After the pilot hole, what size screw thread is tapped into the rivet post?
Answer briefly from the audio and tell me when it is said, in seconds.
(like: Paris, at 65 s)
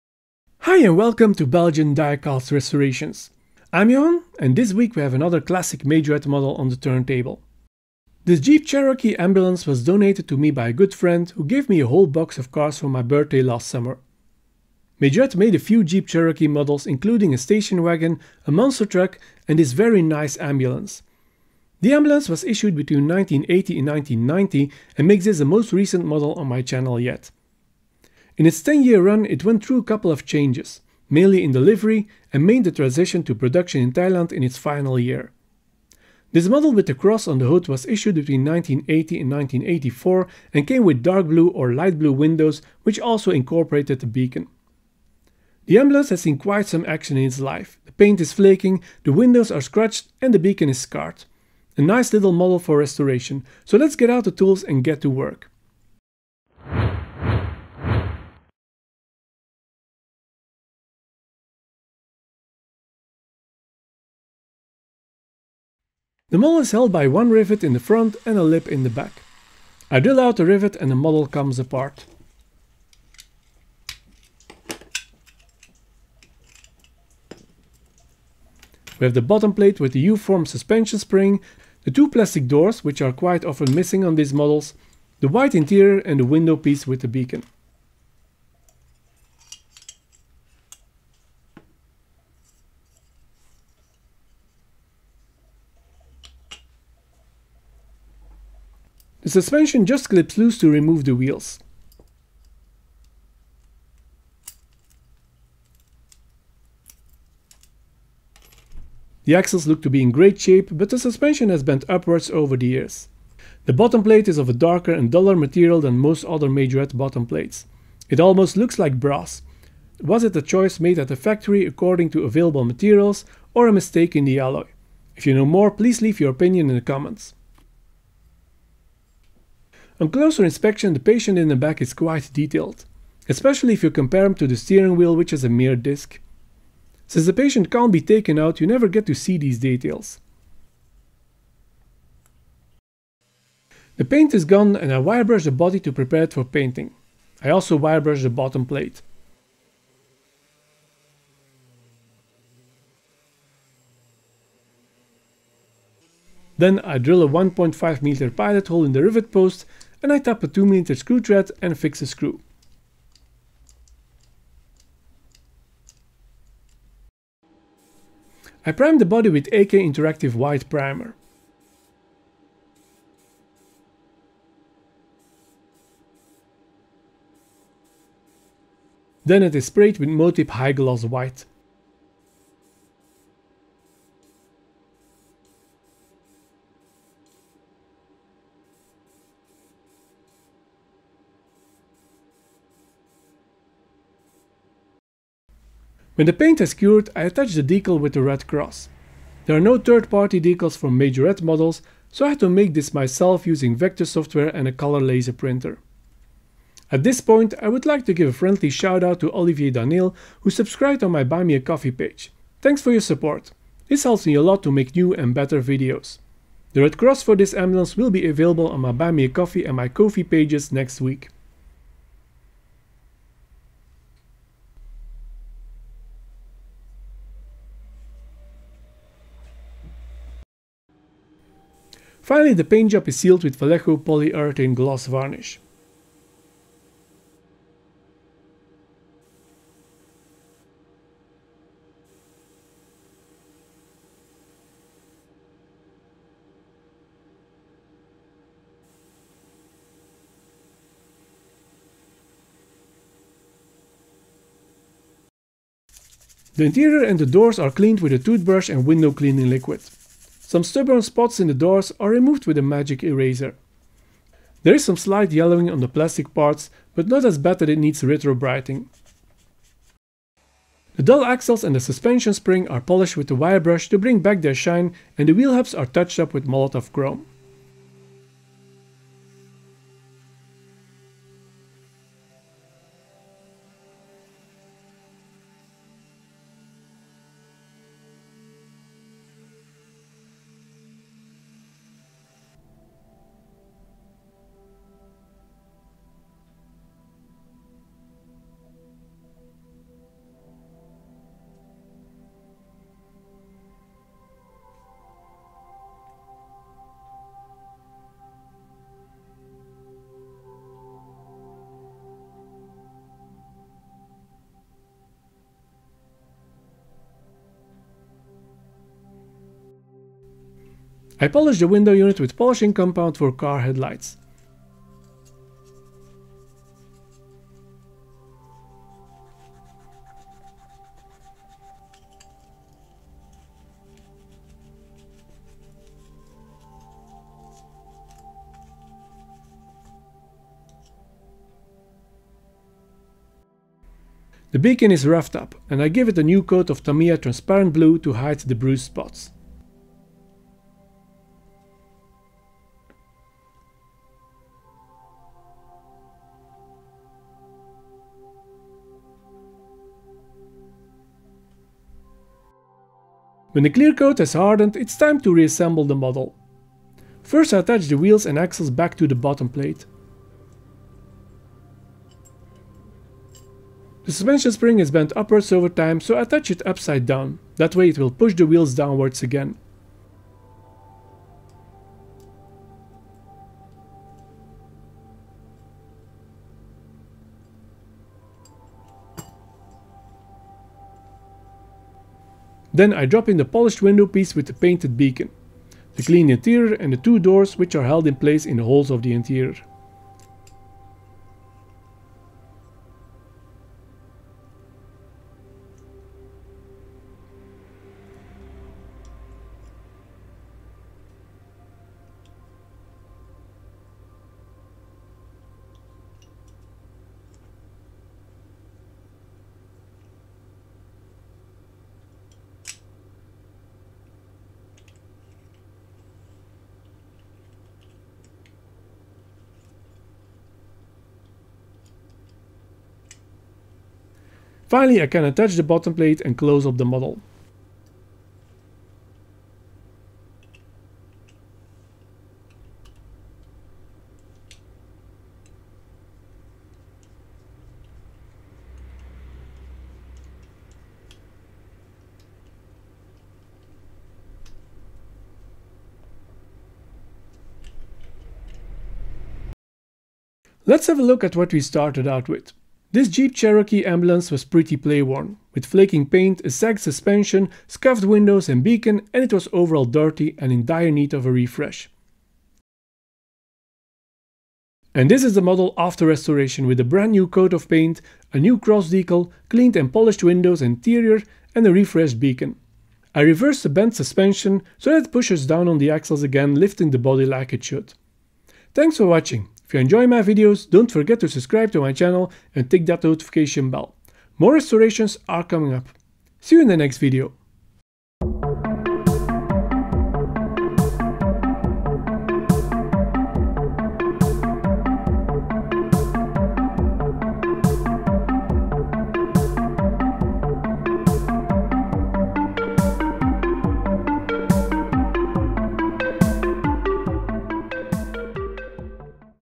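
2mm, at 160 s.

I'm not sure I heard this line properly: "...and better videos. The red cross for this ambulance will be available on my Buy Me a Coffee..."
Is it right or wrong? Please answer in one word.
right.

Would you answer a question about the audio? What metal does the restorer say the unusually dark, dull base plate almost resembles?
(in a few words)
Brass.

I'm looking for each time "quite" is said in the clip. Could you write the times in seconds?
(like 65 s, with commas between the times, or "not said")
46 s, 83 s, 131 s.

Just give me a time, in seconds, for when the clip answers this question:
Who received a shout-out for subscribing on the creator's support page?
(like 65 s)
209 s.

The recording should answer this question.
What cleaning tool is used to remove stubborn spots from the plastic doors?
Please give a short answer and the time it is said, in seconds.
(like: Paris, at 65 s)
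Magic eraser, at 262 s.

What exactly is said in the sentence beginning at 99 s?
The suspension just clips loose to remove the wheels.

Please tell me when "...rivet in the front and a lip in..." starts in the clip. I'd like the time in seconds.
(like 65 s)
67 s.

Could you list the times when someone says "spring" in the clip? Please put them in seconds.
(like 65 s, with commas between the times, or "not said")
80 s, 272 s, 374 s.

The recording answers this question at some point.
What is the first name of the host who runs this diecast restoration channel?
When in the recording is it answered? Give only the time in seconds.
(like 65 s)
3 s.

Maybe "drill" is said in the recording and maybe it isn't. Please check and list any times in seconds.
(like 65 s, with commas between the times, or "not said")
69 s, 156 s.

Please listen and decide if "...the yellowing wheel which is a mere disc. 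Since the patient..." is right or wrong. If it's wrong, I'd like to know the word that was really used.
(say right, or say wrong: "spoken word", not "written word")
wrong: "steering", not "yellowing".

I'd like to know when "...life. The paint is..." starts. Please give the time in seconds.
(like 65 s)
47 s.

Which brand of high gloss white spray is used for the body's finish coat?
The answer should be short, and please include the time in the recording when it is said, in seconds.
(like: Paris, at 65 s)
Motip, at 180 s.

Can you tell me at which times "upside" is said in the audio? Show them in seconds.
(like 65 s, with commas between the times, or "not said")
376 s.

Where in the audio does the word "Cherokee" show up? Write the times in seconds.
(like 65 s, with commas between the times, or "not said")
8 s, 16 s, 463 s.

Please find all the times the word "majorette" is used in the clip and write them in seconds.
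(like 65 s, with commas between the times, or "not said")
5 s, 15 s, 116 s, 200 s.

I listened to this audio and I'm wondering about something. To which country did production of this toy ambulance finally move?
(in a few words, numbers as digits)
Thailand.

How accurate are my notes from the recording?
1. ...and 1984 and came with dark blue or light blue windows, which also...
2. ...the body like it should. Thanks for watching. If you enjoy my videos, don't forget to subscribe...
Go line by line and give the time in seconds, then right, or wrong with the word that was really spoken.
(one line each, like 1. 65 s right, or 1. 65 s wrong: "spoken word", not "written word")
1. 39 s right
2. 486 s right.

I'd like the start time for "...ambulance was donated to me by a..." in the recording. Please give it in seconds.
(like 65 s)
9 s.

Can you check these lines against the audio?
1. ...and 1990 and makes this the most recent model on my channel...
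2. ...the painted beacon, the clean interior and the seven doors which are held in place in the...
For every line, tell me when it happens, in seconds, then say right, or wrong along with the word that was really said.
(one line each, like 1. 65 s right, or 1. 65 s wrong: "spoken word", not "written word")
1. 23 s right
2. 394 s wrong: "two", not "seven".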